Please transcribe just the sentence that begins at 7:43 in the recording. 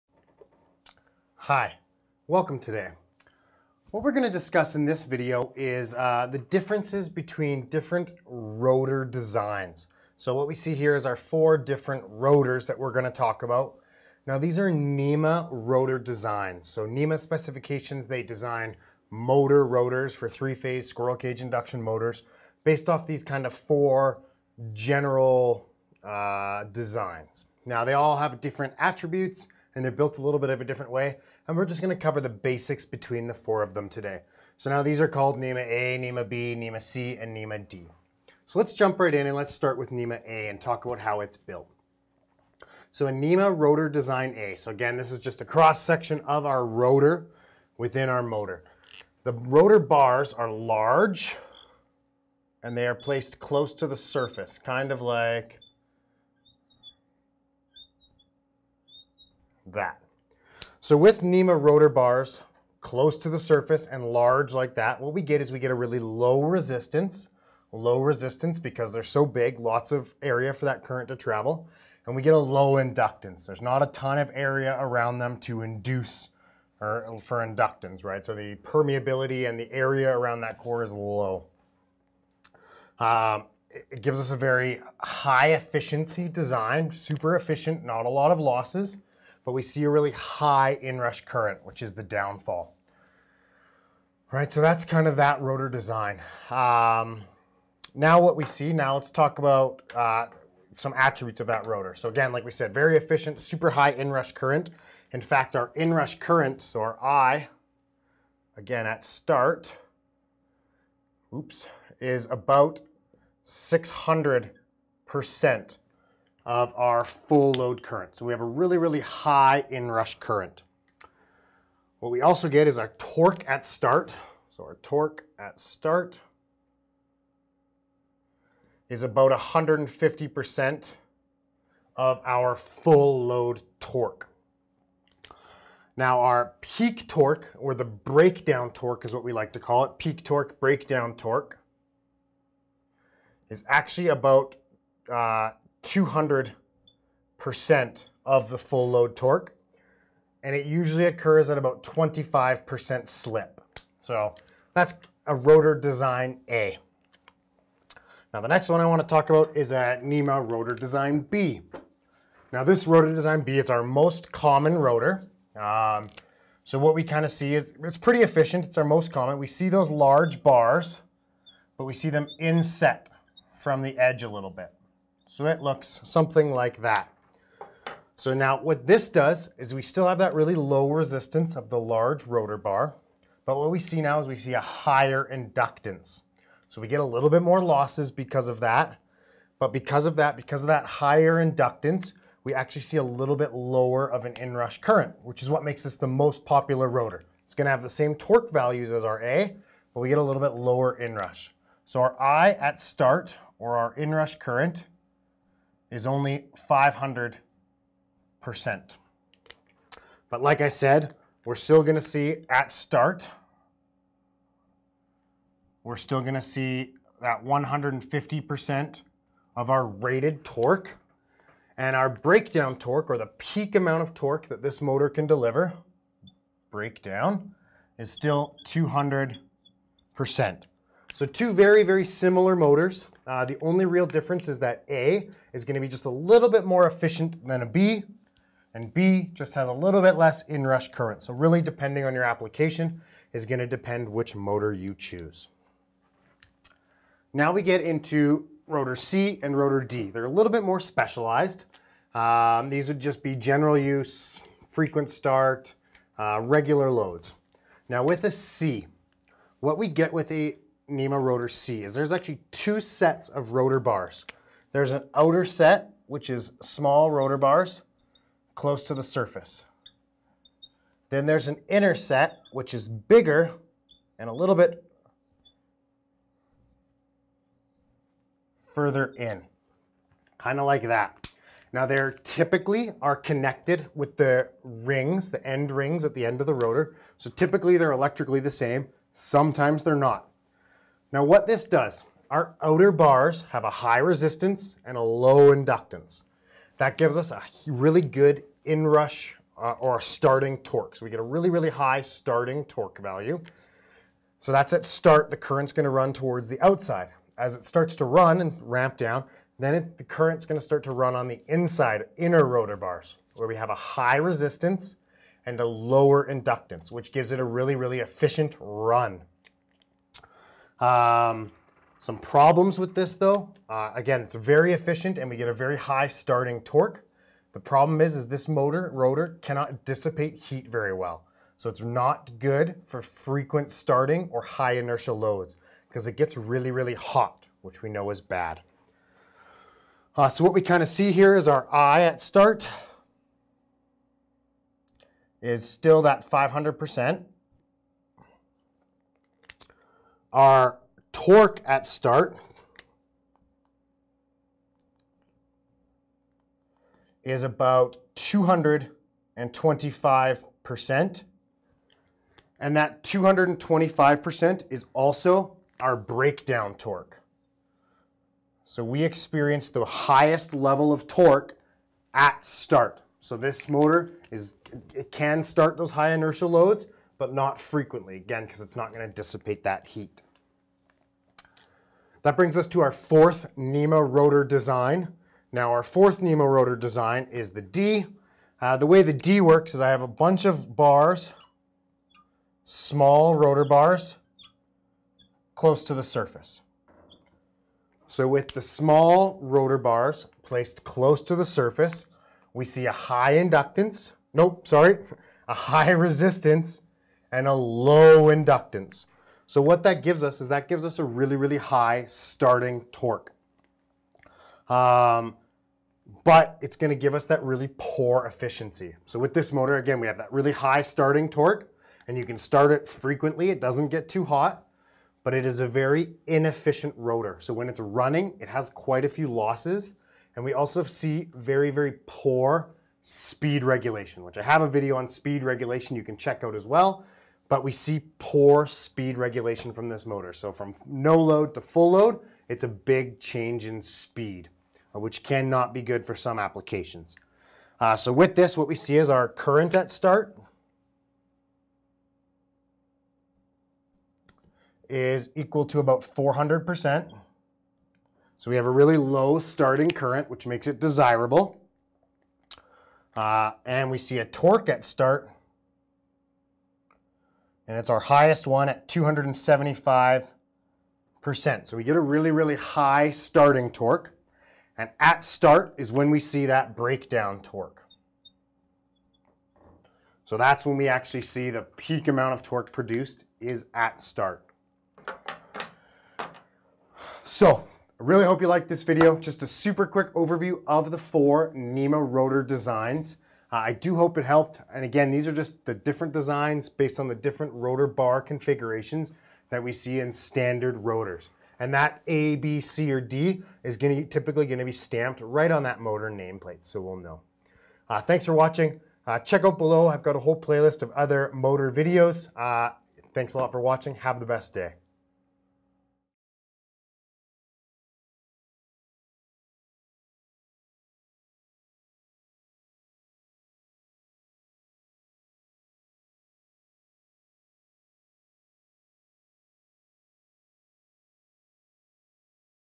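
Uh, and we see a torque at start and it's our highest one at 275%.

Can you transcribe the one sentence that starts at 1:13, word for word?
There's not a ton of area around them to induce or for inductance, right?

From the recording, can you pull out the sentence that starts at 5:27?
The problem is, is this motor rotor cannot dissipate heat very well.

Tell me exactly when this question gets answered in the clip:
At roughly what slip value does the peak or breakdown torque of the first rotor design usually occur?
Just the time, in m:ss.
2:31.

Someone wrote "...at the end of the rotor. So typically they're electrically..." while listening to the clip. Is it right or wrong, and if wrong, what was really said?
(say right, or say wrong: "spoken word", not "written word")
right.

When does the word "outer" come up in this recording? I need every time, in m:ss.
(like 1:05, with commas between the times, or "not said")
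4:25, 4:52.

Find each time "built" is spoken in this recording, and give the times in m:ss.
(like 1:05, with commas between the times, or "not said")
0:29, 0:41.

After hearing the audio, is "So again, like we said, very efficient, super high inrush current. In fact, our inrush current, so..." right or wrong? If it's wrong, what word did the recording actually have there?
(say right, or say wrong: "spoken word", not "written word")
right.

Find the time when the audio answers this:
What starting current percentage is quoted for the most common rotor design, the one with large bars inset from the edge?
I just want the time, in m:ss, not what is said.
3:25.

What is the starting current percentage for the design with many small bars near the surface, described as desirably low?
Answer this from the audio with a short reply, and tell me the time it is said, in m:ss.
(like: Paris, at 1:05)
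400%, at 7:36.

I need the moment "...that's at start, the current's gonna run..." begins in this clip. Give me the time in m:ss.
5:04.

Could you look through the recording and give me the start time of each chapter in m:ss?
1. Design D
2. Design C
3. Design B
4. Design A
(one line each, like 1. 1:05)
1. 6:21
2. 4:06
3. 2:38
4. 0:38.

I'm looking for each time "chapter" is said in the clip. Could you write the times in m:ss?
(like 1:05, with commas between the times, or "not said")
not said.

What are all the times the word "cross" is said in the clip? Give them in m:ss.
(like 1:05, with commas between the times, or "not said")
0:45.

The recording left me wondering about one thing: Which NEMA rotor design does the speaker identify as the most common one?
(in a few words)
NEMA B.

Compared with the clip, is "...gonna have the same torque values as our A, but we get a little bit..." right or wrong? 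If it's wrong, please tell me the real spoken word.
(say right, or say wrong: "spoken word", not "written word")
right.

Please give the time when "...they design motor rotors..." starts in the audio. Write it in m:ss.
0:18.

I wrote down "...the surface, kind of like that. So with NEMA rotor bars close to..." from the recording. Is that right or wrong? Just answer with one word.
right.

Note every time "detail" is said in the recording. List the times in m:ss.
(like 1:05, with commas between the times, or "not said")
not said.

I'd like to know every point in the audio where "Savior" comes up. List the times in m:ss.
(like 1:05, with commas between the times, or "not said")
not said.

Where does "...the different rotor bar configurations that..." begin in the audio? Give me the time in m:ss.
8:17.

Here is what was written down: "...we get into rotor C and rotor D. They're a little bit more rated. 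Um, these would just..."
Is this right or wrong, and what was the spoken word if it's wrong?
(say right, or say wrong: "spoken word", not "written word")
wrong: "specialized", not "rated".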